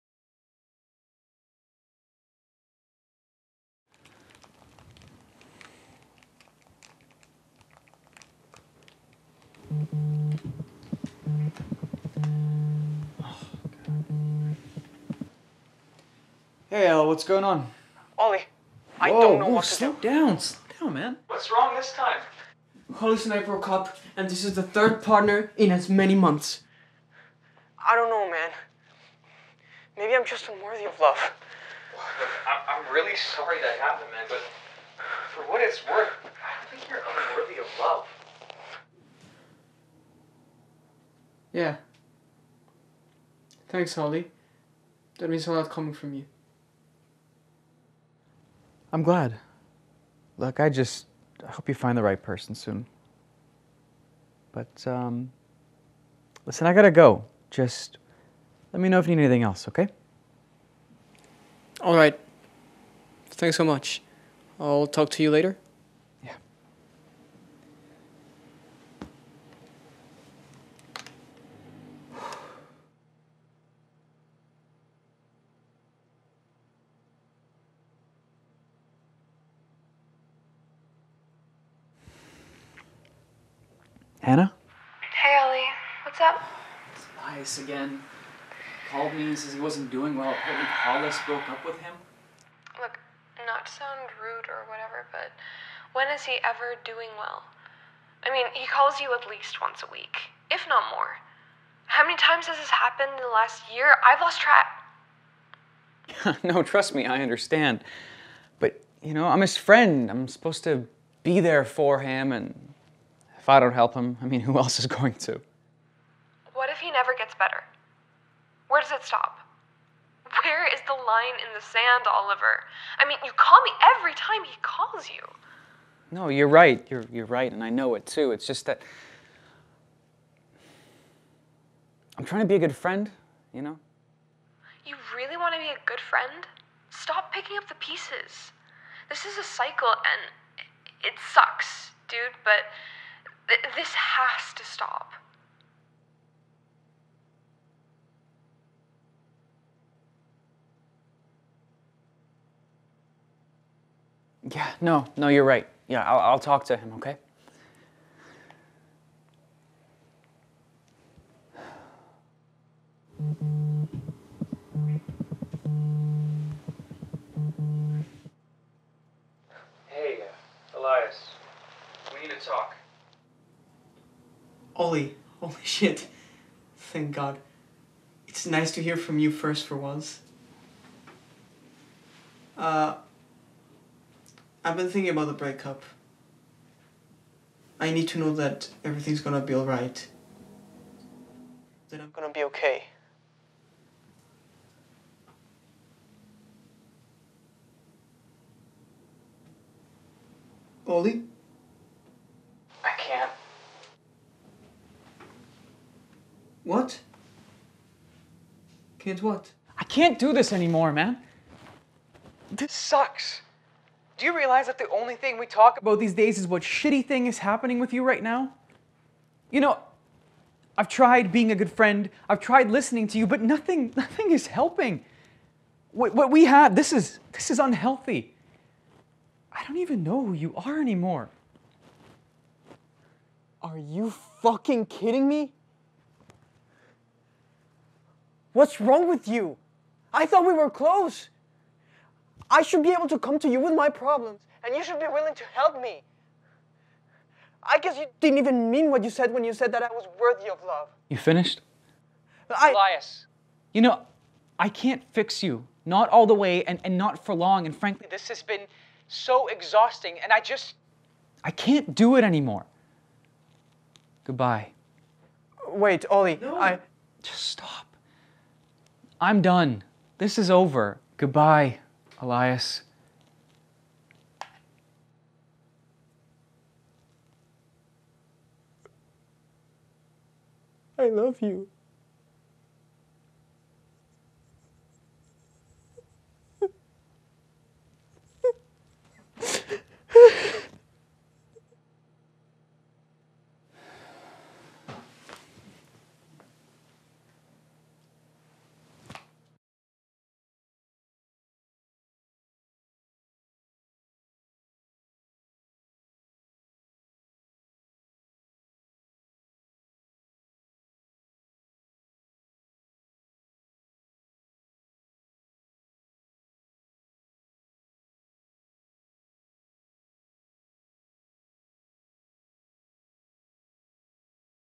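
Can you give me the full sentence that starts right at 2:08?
It's just that I'm trying to be a good friend, you know?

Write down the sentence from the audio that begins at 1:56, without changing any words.
What if he never gets better?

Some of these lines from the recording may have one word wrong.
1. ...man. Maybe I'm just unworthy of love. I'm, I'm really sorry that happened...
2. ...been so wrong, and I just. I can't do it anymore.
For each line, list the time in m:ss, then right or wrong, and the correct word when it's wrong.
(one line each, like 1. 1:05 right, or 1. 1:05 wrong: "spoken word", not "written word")
1. 0:28 right
2. 4:18 wrong: "exhausting", not "wrong".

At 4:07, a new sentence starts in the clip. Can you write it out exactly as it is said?
I guess you didn't even mean what you said when you said that I was worthy of love.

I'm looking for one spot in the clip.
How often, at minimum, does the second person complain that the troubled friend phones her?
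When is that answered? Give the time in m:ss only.
1:39.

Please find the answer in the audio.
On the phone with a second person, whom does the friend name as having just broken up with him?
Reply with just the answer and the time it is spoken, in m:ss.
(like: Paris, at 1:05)
Hollis, at 1:30.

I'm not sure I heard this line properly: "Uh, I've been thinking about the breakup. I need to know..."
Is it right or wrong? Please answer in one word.
right.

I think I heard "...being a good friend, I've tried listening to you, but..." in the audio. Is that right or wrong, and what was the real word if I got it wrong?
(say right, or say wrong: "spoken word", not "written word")
right.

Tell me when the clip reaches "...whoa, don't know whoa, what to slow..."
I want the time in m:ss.
0:19.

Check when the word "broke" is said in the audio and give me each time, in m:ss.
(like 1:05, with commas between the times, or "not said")
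0:23, 1:31.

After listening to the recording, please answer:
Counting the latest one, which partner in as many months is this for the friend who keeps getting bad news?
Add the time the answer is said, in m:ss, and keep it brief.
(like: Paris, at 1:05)
third, at 0:24.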